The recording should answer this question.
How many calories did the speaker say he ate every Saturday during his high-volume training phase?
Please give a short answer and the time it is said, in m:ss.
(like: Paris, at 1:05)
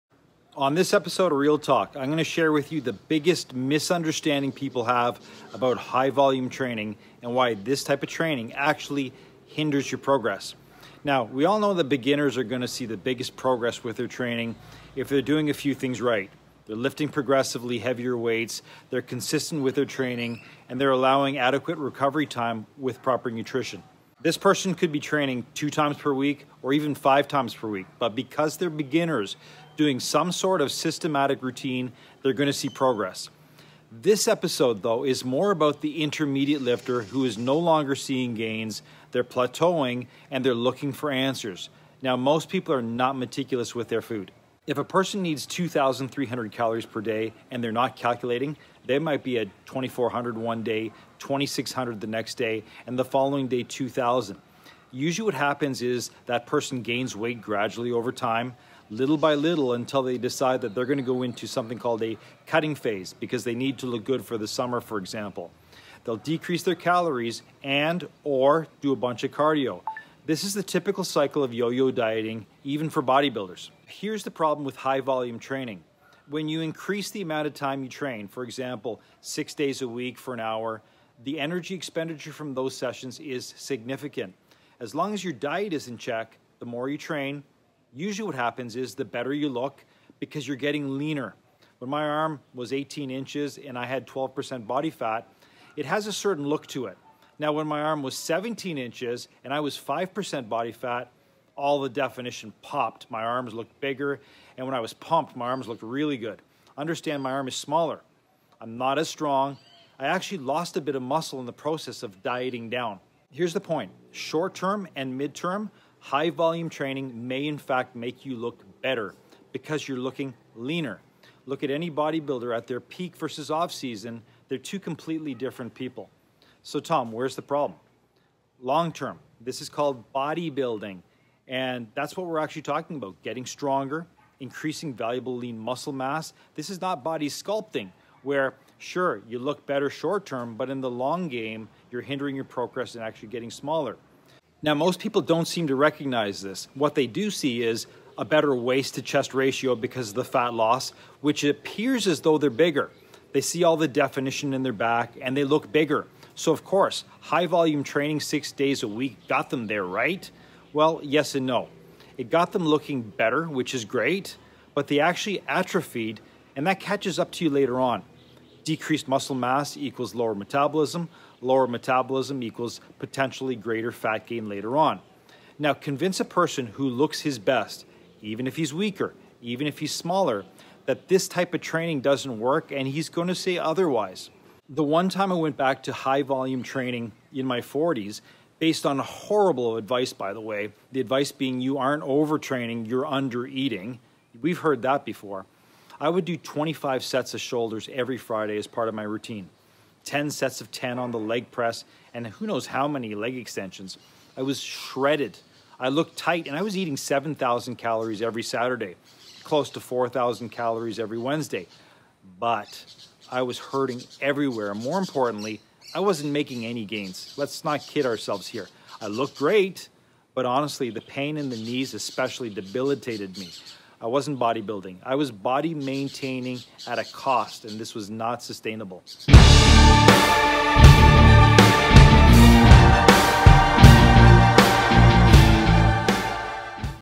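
7,000, at 3:26.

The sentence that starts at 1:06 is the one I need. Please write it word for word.
They'll decrease their calories and or do a bunch of cardio this is the typical cycle of yo-yo dieting, even for bodybuilders.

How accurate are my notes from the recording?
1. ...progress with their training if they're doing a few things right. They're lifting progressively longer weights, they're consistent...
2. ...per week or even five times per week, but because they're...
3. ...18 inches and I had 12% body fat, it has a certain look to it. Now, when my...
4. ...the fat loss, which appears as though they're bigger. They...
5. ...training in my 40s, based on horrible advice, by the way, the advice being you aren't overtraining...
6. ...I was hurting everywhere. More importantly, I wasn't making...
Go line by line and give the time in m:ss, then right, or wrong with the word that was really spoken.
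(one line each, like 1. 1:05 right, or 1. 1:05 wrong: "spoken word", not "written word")
1. 0:13 wrong: "heavier", not "longer"
2. 0:25 right
3. 1:32 right
4. 2:30 right
5. 3:06 right
6. 3:33 right.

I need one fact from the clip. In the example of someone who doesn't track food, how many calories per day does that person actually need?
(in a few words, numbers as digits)
2,300.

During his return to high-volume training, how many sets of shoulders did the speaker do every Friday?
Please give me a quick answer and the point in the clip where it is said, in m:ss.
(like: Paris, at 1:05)
25, at 3:16.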